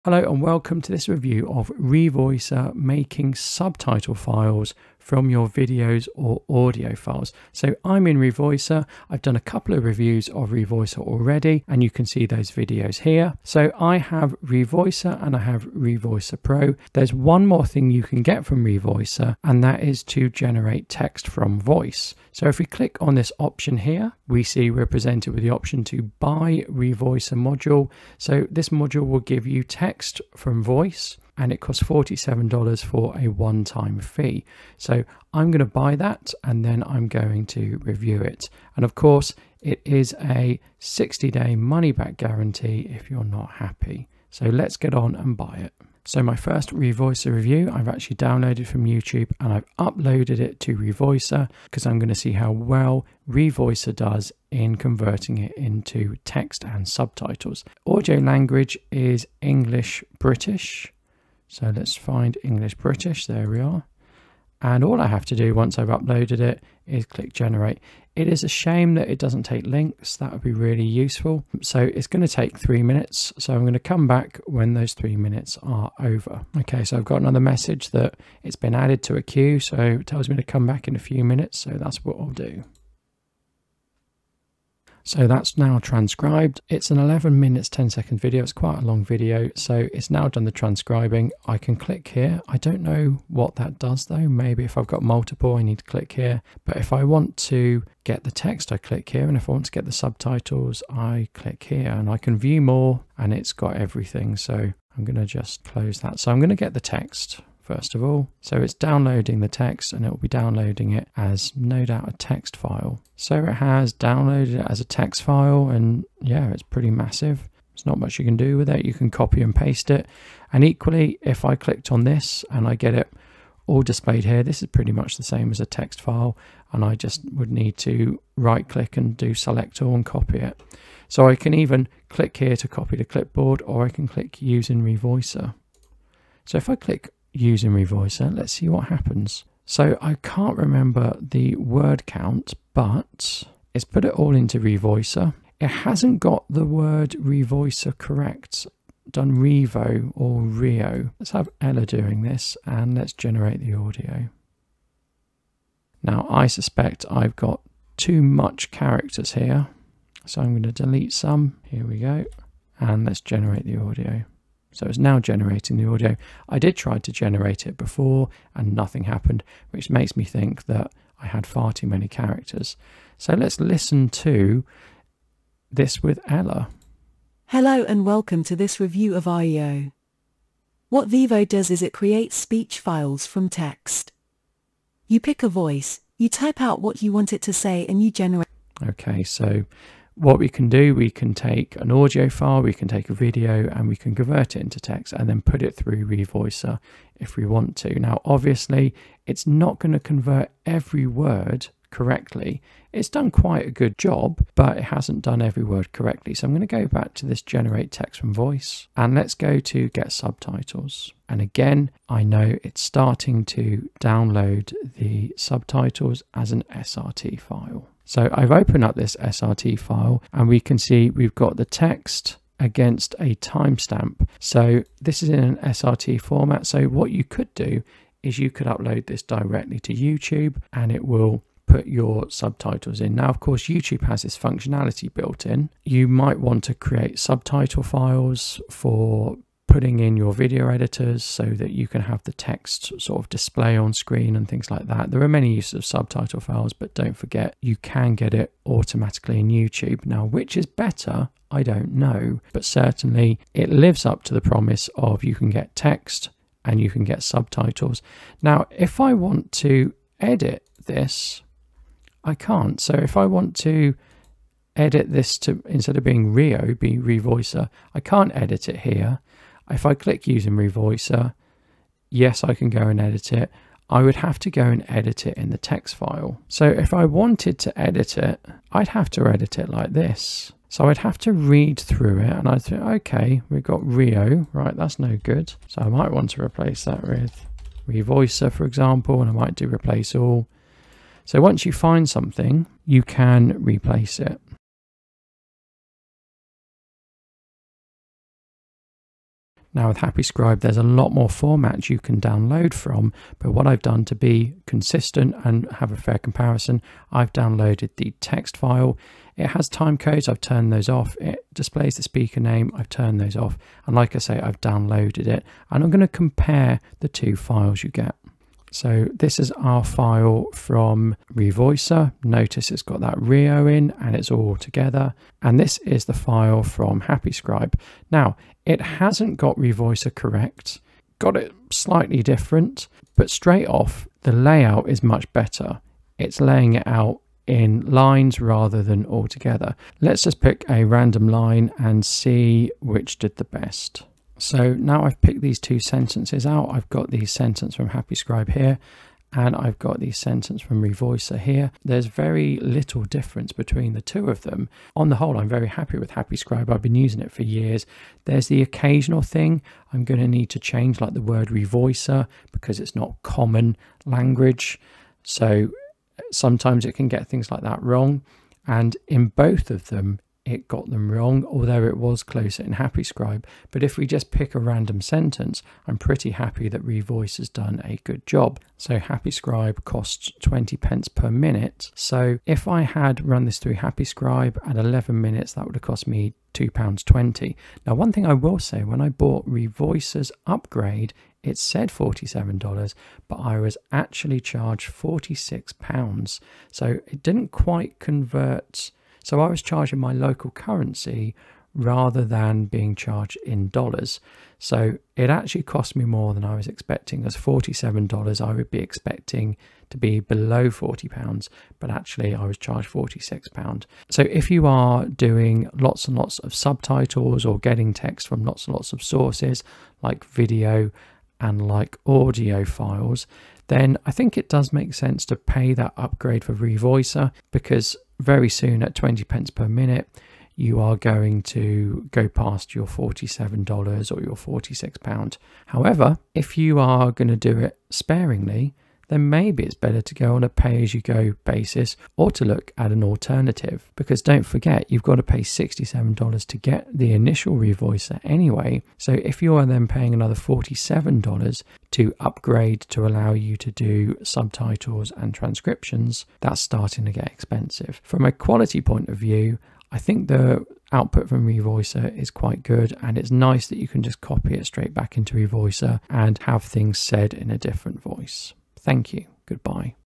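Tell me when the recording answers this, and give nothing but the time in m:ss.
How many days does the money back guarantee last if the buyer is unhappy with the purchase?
0:40.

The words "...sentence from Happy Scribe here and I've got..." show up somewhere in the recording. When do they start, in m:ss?
5:47.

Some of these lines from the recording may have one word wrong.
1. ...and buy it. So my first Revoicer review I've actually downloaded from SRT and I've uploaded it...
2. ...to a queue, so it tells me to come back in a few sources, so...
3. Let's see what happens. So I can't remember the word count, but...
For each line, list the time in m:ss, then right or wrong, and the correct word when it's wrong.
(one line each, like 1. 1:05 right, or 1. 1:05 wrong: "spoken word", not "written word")
1. 0:45 wrong: "YouTube", not "SRT"
2. 1:19 wrong: "minutes", not "sources"
3. 2:18 right.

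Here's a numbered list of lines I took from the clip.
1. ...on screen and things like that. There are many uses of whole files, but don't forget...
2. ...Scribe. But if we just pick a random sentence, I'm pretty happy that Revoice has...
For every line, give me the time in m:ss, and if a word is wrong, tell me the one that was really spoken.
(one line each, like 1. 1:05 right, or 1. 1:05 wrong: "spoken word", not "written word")
1. 4:03 wrong: "subtitle", not "whole"
2. 6:13 right.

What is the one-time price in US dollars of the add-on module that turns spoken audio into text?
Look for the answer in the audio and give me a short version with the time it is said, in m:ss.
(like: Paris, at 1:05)
$47, at 0:31.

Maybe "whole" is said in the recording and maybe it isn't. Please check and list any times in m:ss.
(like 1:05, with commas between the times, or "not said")
5:55.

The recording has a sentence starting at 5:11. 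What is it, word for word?
It displays the speaker name, I've turned those off.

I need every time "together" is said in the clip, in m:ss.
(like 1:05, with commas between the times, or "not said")
5:24, 5:39.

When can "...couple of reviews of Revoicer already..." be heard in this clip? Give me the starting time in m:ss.
0:09.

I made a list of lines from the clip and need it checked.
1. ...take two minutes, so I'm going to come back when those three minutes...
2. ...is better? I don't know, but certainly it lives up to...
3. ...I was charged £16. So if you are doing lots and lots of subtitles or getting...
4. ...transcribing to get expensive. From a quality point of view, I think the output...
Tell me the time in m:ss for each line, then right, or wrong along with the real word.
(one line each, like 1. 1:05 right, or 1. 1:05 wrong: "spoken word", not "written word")
1. 1:12 wrong: "three", not "two"
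2. 4:10 right
3. 6:52 wrong: "46", not "16"
4. 7:36 wrong: "starting", not "transcribing".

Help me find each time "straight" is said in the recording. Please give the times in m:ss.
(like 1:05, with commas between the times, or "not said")
5:33, 7:44.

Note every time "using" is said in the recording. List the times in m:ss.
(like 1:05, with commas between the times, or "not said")
2:17, 4:30, 5:56.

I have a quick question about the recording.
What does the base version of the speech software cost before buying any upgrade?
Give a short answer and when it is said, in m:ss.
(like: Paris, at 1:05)
$67, at 7:25.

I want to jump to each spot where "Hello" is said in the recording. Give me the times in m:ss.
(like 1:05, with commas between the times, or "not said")
0:00, 2:57.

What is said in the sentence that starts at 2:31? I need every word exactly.
Let's have Ella doing this and let's generate the audio.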